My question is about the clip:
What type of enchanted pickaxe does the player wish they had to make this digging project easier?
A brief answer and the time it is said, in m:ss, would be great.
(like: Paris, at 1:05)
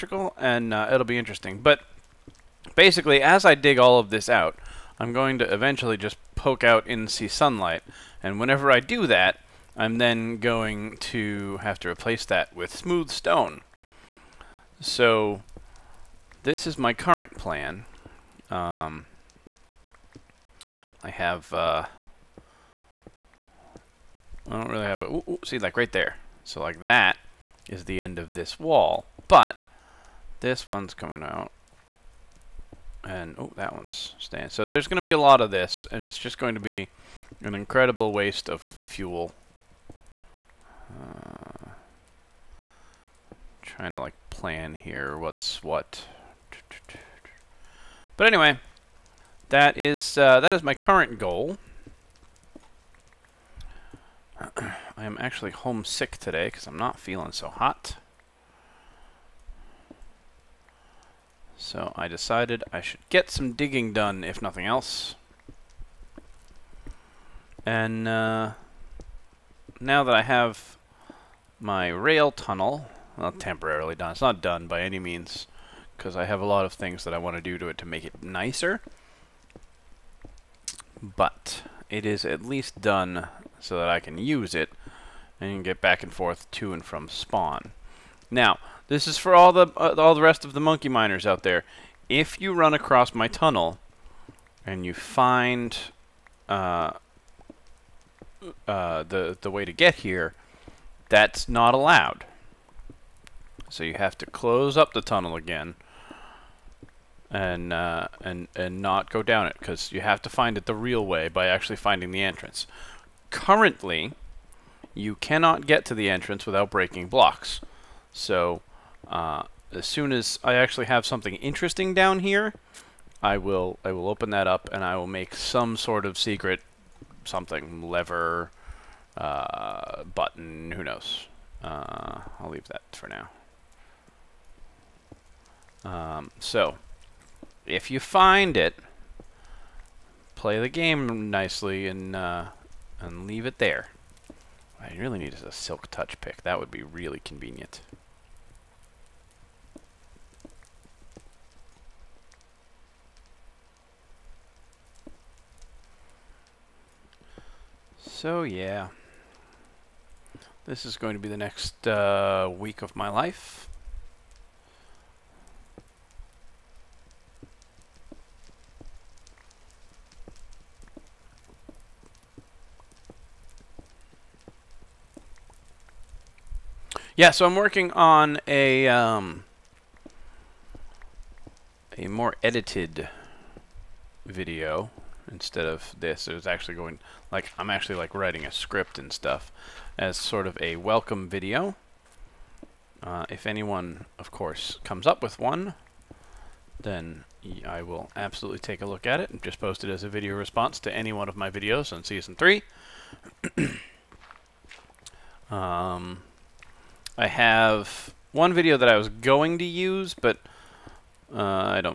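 Silk touch, at 2:25.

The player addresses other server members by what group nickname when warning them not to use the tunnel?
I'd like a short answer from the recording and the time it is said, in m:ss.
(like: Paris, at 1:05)
Monkey miners, at 1:30.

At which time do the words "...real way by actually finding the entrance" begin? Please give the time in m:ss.
1:50.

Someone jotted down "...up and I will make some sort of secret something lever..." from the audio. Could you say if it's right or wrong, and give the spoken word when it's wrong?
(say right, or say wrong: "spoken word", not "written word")
right.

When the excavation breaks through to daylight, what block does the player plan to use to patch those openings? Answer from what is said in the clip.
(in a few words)
Smooth stone.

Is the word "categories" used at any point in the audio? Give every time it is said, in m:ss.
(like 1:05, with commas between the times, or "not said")
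not said.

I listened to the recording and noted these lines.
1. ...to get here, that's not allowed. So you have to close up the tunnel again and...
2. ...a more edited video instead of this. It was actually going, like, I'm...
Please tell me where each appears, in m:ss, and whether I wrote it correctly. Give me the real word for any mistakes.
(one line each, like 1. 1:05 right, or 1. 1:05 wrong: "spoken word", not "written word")
1. 1:39 right
2. 3:01 right.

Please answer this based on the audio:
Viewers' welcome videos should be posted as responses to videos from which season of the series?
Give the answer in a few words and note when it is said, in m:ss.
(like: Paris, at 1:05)
Season 3, at 3:22.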